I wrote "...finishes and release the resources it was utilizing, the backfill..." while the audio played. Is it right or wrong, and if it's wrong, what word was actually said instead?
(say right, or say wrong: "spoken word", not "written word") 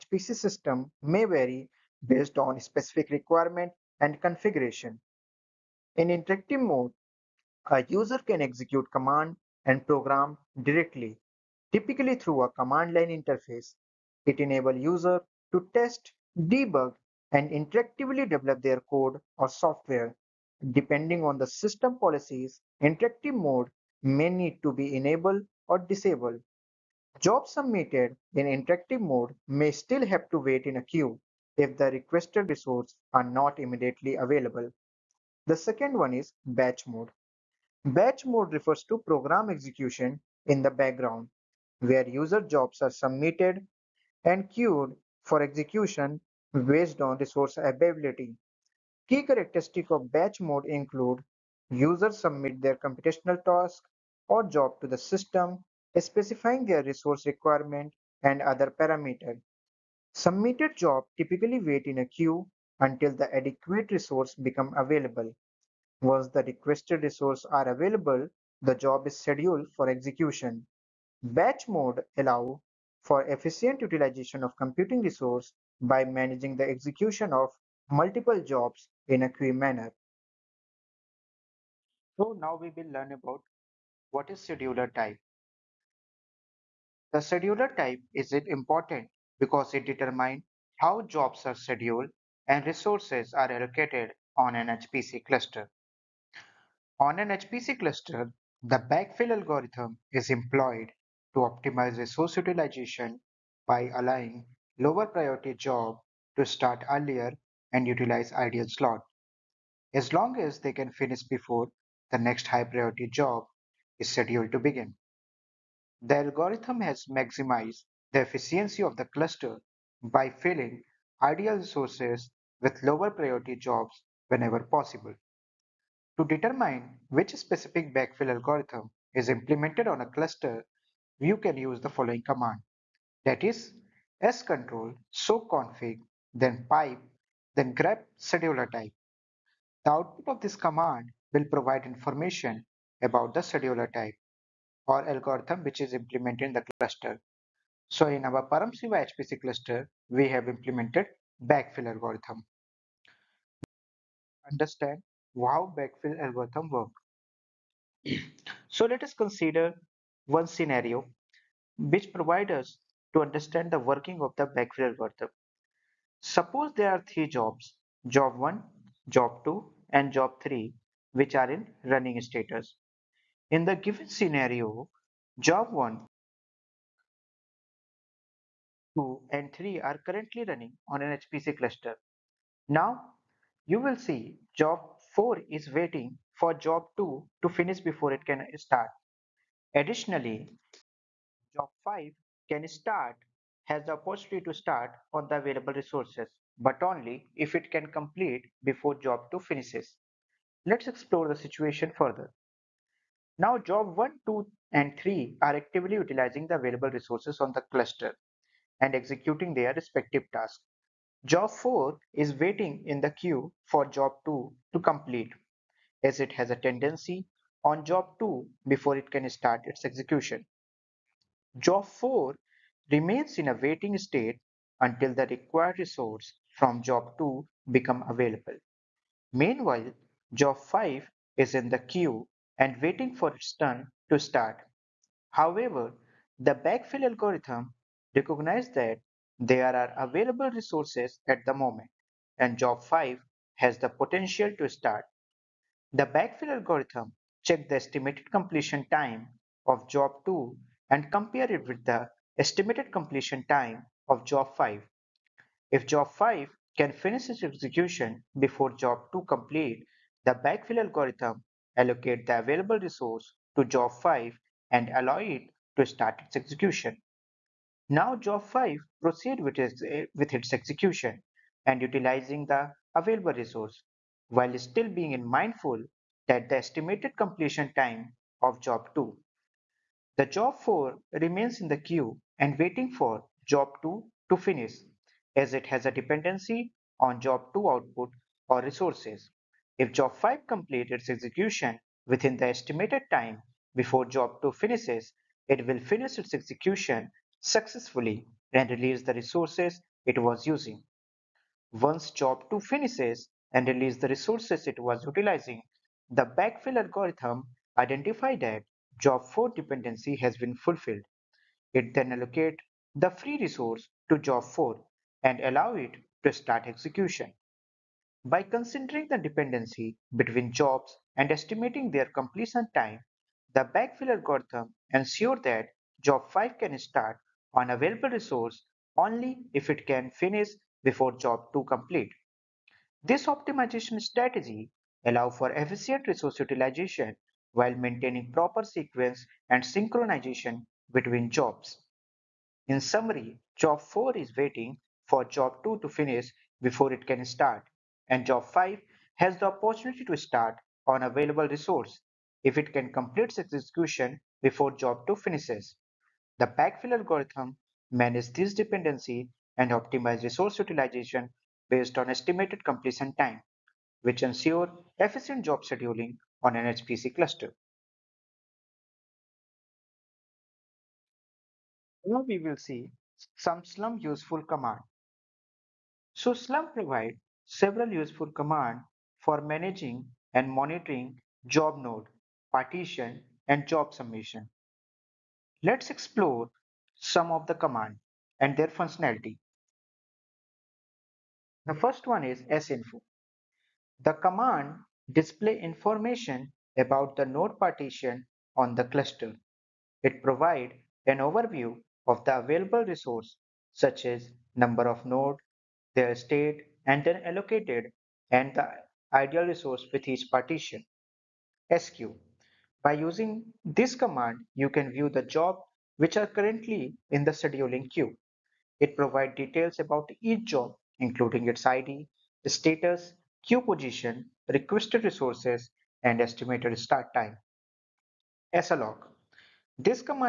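right.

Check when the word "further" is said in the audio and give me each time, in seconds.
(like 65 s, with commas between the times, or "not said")
201 s.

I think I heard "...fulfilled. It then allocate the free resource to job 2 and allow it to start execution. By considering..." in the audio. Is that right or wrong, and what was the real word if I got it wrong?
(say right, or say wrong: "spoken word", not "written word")
wrong: "4", not "2".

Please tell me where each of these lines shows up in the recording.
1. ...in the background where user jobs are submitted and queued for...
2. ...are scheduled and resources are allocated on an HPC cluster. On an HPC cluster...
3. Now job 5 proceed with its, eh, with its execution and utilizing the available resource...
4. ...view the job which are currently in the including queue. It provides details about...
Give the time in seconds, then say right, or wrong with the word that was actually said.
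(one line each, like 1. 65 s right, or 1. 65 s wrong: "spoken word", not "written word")
1. 40 s right
2. 91 s right
3. 267 s right
4. 414 s wrong: "scheduling", not "including".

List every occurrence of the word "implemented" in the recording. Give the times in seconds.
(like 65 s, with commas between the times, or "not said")
129 s, 145 s, 150 s.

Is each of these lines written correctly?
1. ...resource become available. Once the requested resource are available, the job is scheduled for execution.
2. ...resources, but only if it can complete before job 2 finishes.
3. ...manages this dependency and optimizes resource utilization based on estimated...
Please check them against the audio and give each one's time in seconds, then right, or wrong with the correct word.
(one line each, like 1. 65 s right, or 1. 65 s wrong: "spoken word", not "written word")
1. 63 s right
2. 195 s right
3. 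357 s right.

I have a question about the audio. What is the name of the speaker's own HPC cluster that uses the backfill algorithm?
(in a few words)
Paramsiva.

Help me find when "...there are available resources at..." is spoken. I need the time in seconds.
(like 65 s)
239 s.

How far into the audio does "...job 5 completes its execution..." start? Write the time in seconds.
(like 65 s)
289 s.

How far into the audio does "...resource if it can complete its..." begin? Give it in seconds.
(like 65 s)
351 s.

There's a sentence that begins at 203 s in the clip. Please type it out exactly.
Now job 1, 2 and 3 are actively utilizing the available resources on the cluster and executing their respective tasks.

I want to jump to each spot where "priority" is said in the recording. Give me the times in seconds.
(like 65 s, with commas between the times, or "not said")
105 s, 112 s, 123 s.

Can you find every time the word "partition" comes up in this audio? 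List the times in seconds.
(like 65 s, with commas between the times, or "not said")
382 s, 397 s, 410 s.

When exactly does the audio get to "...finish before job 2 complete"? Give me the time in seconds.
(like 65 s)
330 s.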